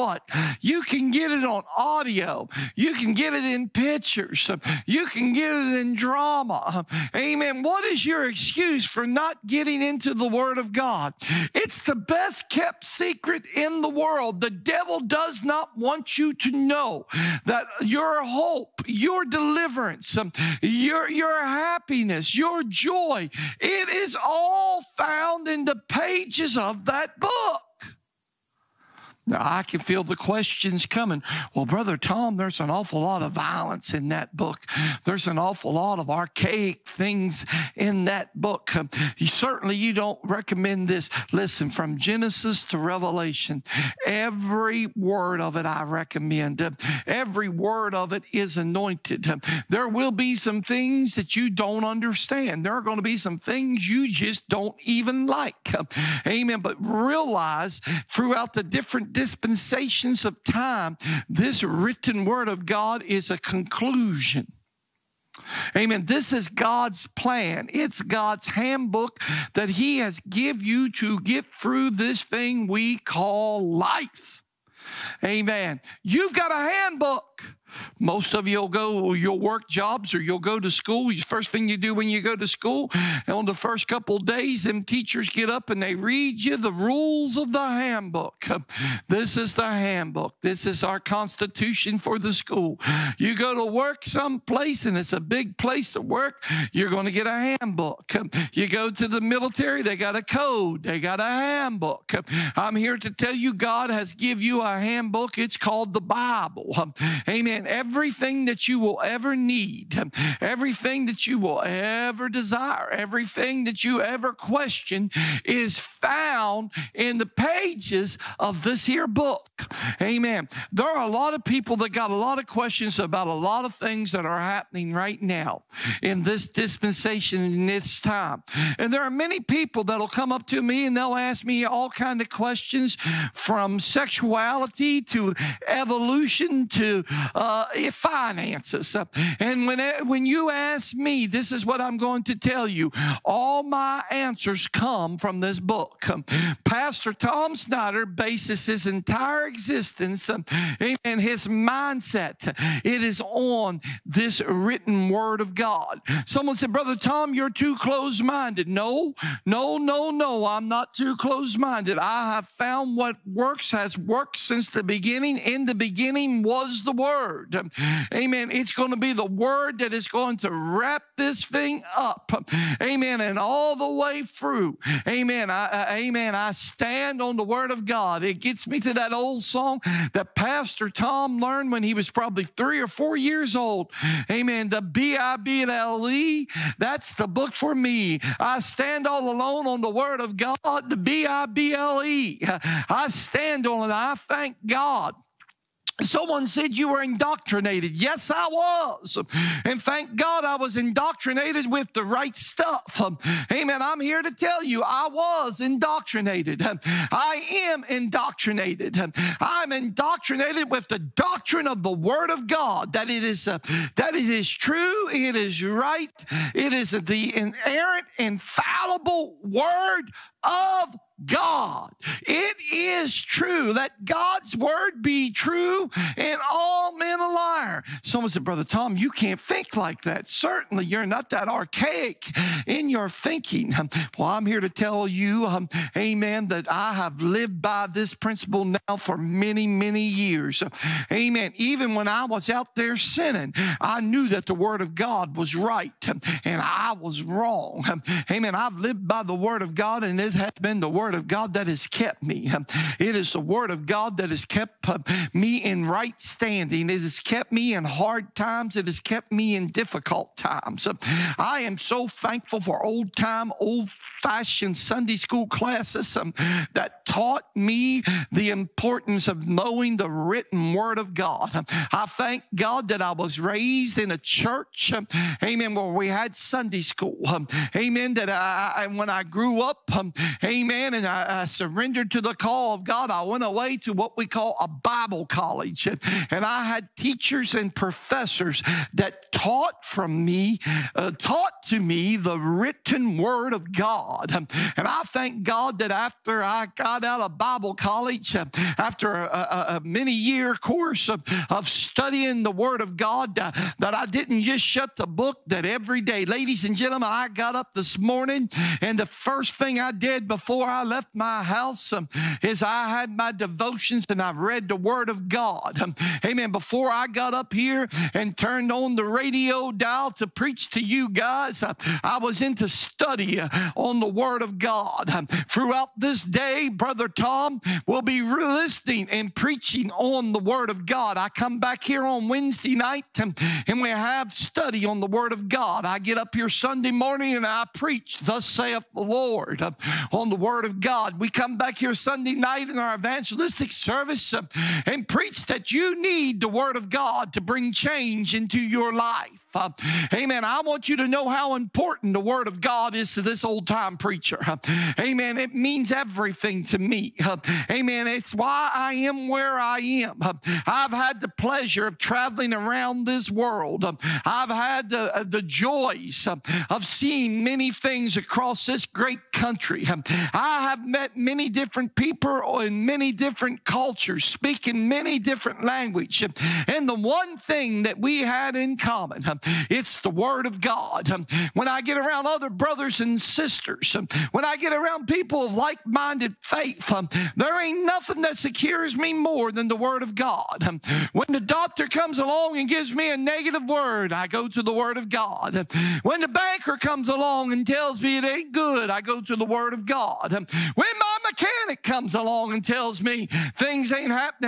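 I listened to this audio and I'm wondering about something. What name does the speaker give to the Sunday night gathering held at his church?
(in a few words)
evangelistic service.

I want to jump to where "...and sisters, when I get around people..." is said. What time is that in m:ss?
6:22.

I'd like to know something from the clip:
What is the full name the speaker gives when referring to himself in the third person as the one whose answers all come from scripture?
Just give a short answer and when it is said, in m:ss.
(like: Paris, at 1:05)
Pastor Tom Snyder, at 2:26.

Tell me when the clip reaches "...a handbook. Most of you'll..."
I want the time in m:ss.
1:16.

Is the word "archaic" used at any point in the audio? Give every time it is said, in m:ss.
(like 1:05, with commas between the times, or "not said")
0:36, 3:51.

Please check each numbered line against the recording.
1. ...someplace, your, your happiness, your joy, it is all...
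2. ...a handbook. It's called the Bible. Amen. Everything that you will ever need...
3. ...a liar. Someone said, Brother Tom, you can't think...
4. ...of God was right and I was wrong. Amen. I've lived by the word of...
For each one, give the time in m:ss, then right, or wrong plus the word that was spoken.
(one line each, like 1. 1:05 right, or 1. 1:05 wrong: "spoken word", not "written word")
1. 0:19 wrong: "deliverance", not "someplace"
2. 1:44 right
3. 3:47 right
4. 4:04 right.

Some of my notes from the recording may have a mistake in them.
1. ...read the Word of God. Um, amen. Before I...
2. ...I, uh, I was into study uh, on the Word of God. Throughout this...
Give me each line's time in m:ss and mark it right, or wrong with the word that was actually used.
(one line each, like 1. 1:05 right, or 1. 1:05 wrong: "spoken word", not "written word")
1. 5:14 right
2. 5:21 right.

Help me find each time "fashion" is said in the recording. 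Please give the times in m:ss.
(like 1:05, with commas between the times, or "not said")
4:24.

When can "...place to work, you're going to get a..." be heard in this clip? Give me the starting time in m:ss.
1:35.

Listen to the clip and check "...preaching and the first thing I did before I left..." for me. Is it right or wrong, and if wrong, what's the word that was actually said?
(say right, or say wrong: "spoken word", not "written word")
wrong: "morning", not "preaching".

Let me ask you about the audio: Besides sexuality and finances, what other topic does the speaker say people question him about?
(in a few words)
evolution.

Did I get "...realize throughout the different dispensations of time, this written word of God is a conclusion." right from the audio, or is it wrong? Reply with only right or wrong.
right.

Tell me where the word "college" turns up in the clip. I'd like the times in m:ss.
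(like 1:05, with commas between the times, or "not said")
4:45, 4:57.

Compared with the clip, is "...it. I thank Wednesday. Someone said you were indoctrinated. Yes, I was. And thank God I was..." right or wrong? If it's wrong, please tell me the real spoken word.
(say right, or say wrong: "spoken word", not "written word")
wrong: "God", not "Wednesday".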